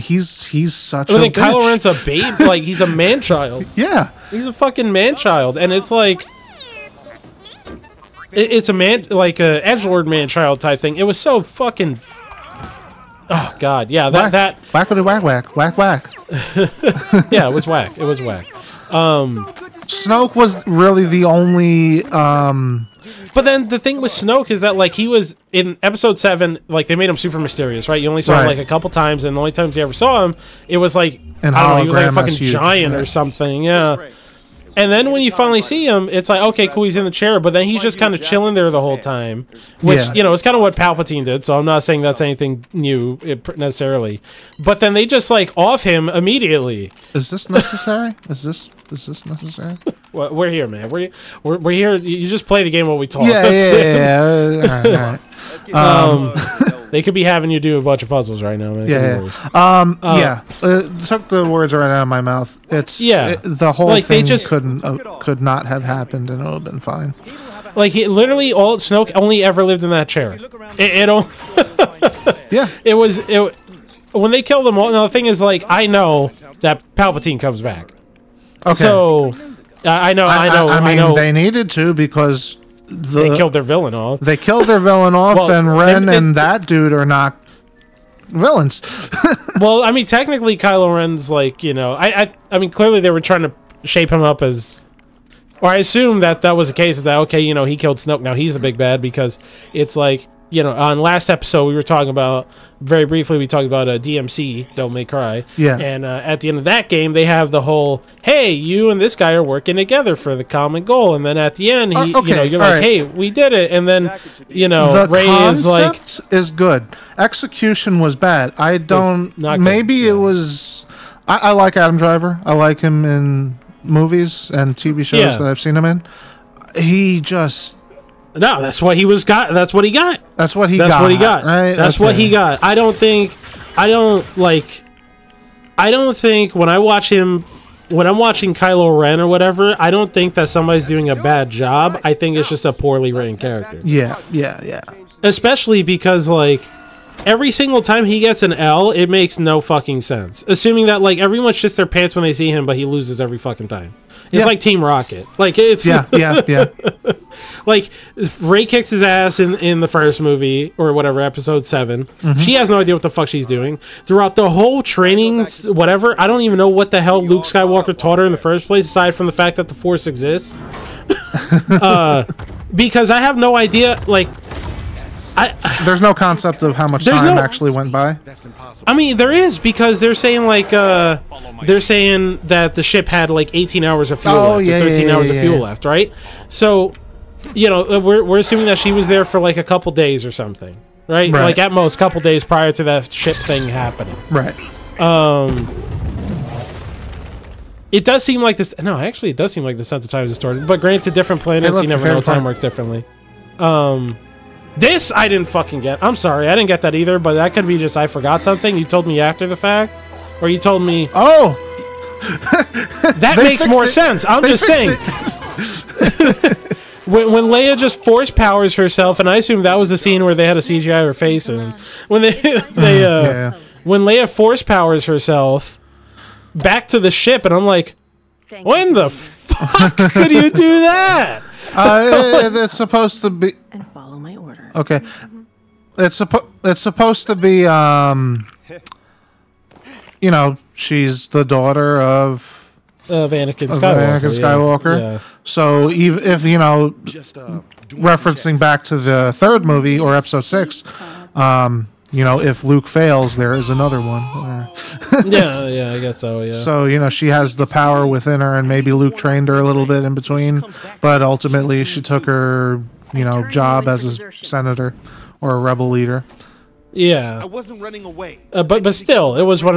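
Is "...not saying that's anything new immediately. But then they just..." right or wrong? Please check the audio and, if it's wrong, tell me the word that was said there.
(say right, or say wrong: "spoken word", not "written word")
wrong: "necessarily", not "immediately".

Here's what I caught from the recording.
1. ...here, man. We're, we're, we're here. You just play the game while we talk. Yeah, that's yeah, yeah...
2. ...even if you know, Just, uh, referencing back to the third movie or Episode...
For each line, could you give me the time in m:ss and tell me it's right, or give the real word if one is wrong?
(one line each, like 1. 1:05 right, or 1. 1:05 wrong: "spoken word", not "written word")
1. 0:50 right
2. 4:05 right.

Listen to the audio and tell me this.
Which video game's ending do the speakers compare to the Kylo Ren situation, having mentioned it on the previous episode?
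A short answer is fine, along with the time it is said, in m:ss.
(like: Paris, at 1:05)
Devil May Cry, at 1:44.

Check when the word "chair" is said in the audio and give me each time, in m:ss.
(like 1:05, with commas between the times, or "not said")
0:37, 1:10.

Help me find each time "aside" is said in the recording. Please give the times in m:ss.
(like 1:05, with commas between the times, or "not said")
2:48.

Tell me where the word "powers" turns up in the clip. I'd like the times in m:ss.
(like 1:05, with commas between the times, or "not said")
3:38, 3:44, 4:17.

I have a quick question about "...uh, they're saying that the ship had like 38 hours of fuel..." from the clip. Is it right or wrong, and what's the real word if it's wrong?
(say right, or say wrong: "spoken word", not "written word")
wrong: "18", not "38".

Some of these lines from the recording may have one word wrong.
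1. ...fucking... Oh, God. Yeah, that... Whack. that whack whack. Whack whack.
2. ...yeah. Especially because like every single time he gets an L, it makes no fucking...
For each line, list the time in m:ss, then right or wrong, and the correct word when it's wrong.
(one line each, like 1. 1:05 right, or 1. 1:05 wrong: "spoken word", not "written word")
1. 0:11 right
2. 2:24 right.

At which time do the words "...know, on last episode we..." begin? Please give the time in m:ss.
1:40.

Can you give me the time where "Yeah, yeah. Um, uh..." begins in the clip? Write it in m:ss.
0:58.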